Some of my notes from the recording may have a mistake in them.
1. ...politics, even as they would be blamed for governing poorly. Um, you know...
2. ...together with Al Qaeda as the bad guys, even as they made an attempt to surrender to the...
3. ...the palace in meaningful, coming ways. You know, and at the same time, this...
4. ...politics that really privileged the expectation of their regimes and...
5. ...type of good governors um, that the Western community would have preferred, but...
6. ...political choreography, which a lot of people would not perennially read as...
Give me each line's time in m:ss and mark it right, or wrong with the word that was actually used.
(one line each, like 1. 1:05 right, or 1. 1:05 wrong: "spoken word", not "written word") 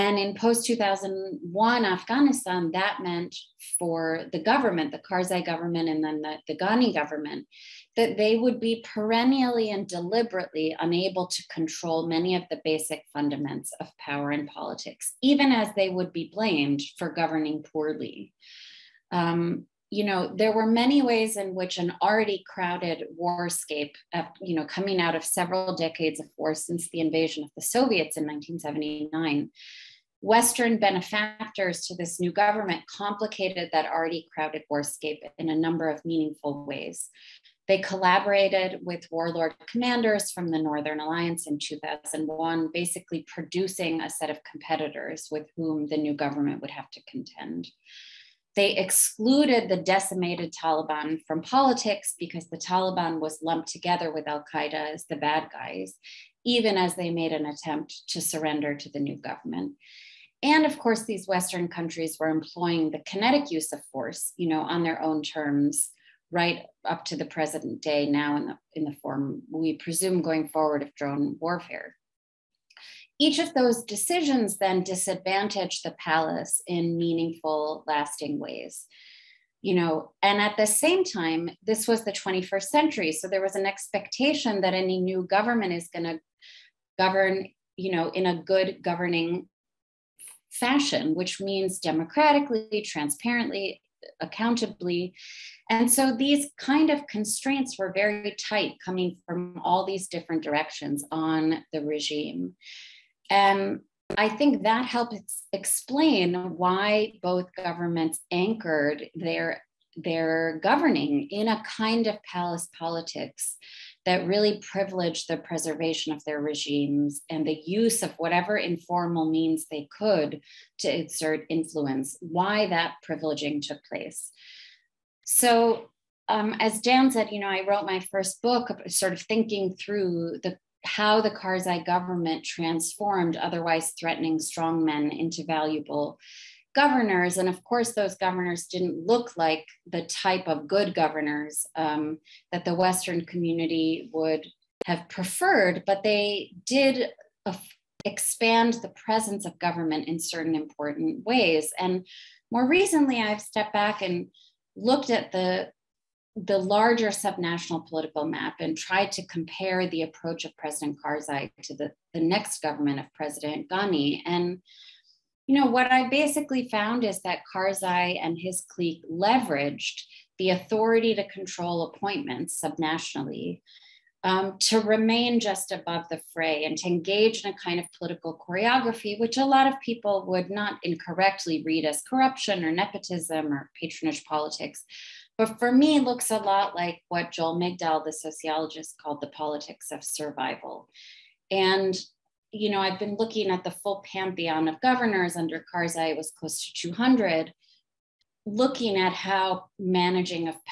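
1. 0:14 right
2. 0:53 right
3. 1:15 wrong: "lasting", not "coming"
4. 1:52 wrong: "preservation", not "expectation"
5. 2:20 right
6. 2:57 wrong: "incorrectly", not "perennially".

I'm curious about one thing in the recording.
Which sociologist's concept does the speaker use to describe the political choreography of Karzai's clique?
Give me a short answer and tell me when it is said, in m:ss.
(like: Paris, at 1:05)
Joel Migdal, at 3:07.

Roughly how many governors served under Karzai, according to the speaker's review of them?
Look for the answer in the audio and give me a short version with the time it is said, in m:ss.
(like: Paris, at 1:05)
Close to 200, at 3:16.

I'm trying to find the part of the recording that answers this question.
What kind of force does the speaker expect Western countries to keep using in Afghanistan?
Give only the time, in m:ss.
1:10.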